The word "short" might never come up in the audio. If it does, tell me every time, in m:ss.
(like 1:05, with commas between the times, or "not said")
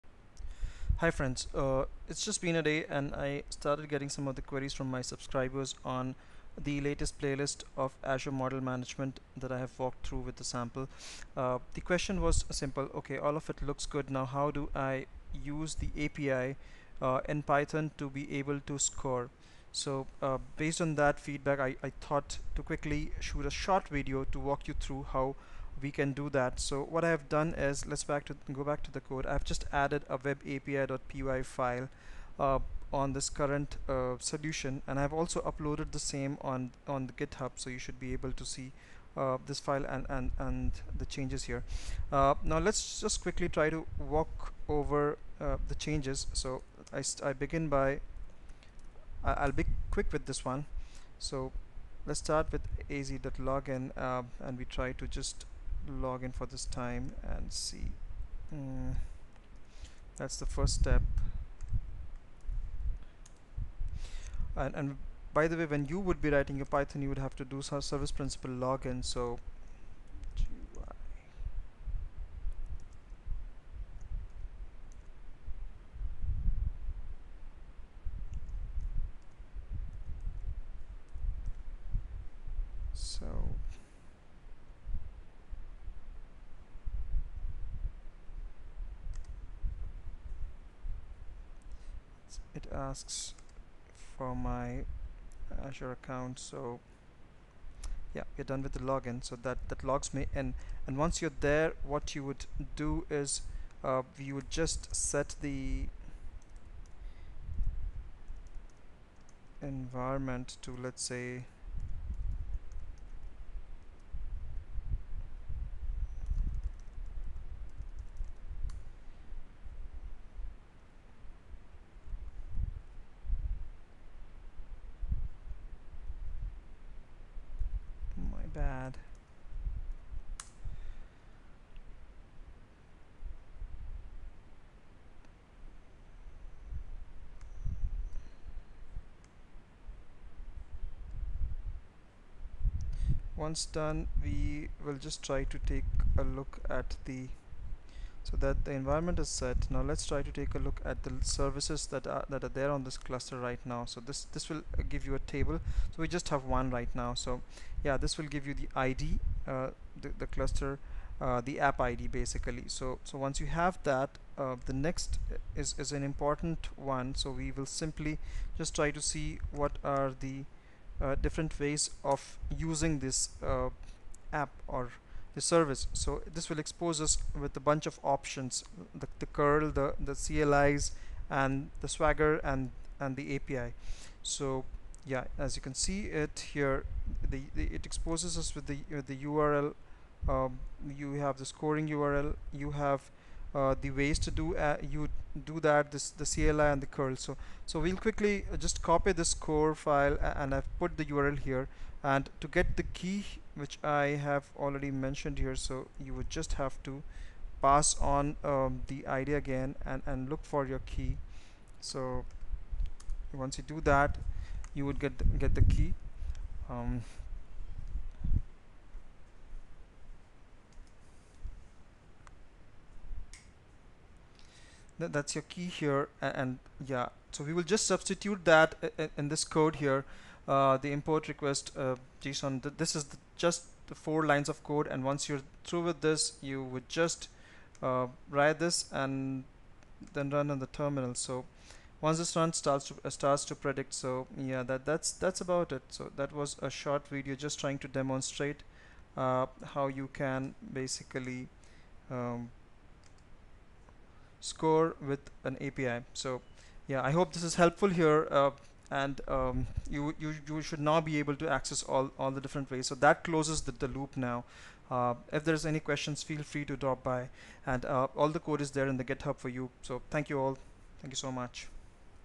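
0:23, 4:06.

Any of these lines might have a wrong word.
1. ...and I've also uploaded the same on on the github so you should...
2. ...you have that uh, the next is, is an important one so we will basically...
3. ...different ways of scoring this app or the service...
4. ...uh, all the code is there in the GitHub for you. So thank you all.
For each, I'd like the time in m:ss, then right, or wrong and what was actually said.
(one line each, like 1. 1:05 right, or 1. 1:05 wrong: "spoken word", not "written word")
1. 0:34 right
2. 2:43 wrong: "simply", not "basically"
3. 2:51 wrong: "using", not "scoring"
4. 4:27 right.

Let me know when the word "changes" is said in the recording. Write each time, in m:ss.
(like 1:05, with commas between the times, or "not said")
0:41, 0:45.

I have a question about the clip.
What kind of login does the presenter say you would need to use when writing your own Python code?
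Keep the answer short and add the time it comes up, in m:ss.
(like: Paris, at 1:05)
service principal login, at 1:07.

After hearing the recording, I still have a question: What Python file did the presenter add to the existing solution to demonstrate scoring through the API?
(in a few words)
web api.py.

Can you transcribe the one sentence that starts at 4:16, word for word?
So yeah, I hope this is helpful here.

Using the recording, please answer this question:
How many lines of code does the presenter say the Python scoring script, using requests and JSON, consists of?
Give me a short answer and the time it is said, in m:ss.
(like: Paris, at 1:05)
4, at 3:54.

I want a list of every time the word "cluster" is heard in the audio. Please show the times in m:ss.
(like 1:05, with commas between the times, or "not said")
2:32, 2:40.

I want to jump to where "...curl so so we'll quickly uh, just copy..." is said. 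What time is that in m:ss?
3:16.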